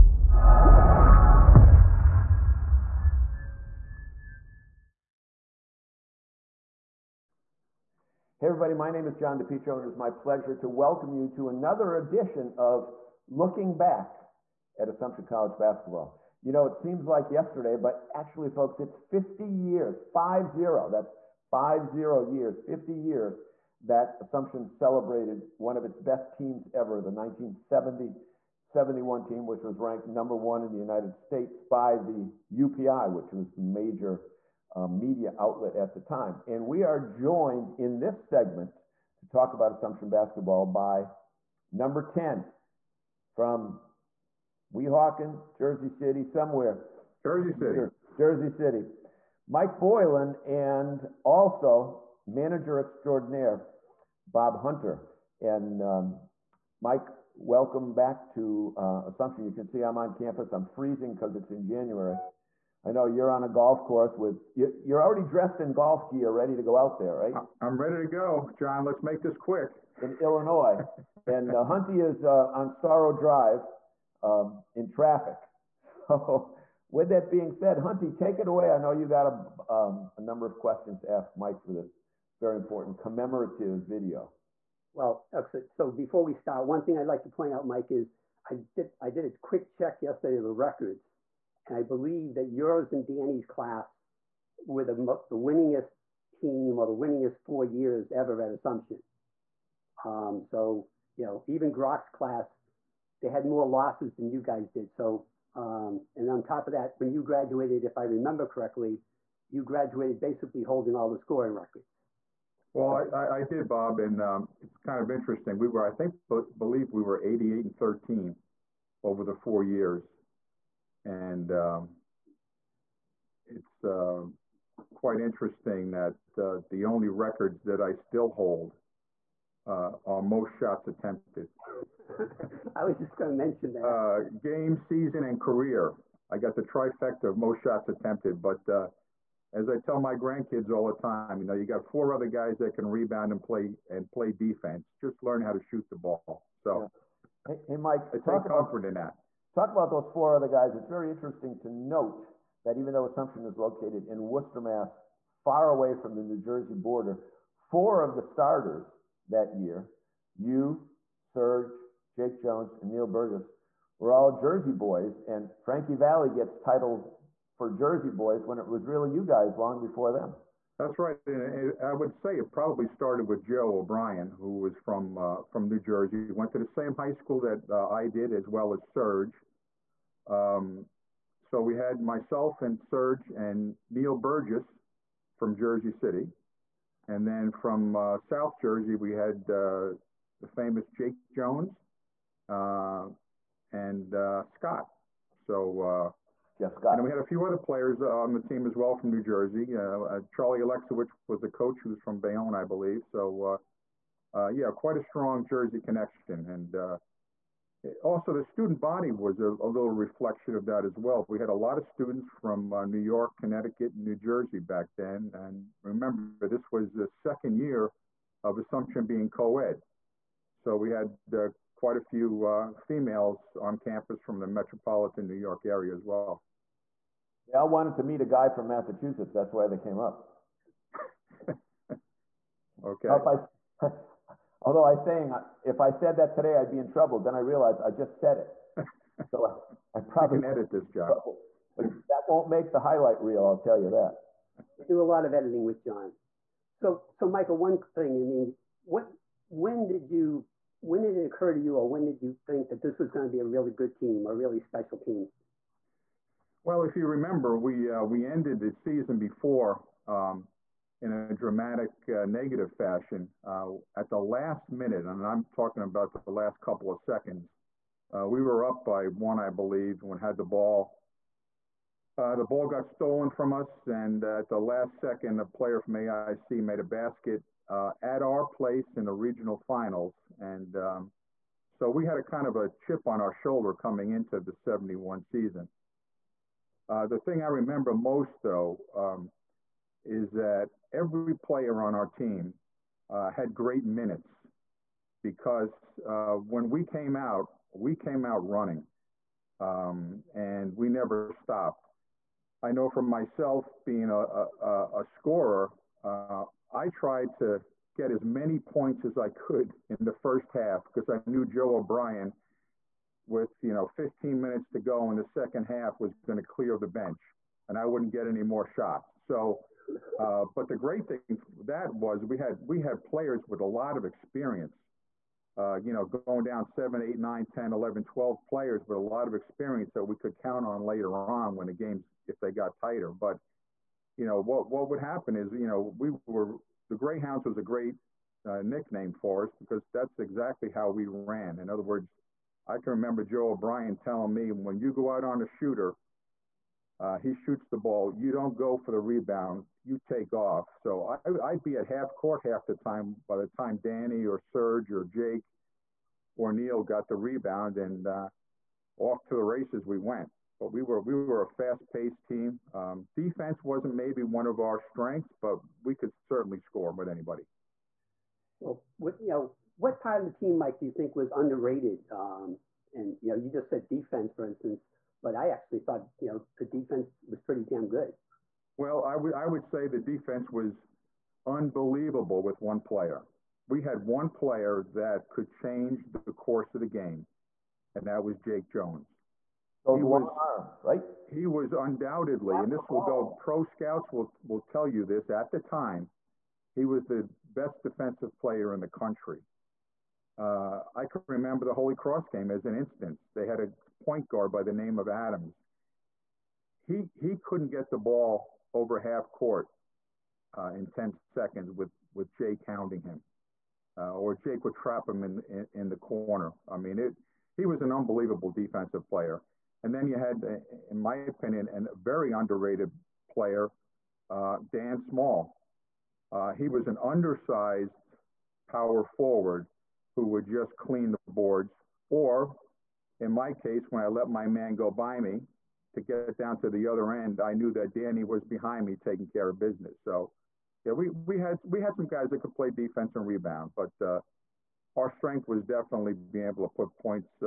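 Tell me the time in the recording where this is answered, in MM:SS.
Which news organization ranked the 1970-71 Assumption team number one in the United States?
00:32.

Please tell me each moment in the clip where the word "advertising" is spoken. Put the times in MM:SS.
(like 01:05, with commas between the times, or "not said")
not said.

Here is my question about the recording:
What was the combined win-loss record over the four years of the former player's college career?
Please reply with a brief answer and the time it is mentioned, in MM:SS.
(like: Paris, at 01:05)
88 and 13, at 01:57.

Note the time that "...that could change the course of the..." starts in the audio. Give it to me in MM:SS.
06:24.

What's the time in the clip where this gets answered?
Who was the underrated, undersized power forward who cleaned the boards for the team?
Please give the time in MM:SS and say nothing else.
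07:04.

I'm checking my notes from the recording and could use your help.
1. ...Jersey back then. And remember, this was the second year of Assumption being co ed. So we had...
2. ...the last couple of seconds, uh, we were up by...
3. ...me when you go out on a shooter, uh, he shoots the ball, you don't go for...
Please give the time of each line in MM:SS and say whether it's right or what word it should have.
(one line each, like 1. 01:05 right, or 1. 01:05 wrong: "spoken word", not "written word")
1. 03:34 right
2. 04:26 right
3. 05:44 right.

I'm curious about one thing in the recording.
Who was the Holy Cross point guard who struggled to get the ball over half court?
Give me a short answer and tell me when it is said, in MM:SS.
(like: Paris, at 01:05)
Adams, at 06:45.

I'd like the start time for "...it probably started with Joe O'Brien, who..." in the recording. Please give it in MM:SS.
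02:52.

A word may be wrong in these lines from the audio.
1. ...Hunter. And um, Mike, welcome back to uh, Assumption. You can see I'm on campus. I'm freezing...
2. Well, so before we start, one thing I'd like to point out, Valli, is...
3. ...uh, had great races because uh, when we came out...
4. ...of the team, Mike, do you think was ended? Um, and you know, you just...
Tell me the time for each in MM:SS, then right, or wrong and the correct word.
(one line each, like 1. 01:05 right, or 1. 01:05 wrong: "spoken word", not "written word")
1. 00:54 right
2. 01:24 wrong: "Mike", not "Valli"
3. 04:53 wrong: "minutes", not "races"
4. 06:10 wrong: "underrated", not "ended".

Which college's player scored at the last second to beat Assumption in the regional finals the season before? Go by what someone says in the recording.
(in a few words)
AIC.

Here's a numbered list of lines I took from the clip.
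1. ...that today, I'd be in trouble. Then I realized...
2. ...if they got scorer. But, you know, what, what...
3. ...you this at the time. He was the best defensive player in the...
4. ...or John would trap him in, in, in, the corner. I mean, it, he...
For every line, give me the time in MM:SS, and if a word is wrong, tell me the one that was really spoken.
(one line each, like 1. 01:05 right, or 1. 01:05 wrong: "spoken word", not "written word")
1. 03:56 right
2. 05:32 wrong: "tighter", not "scorer"
3. 06:34 right
4. 06:54 wrong: "Jake", not "John".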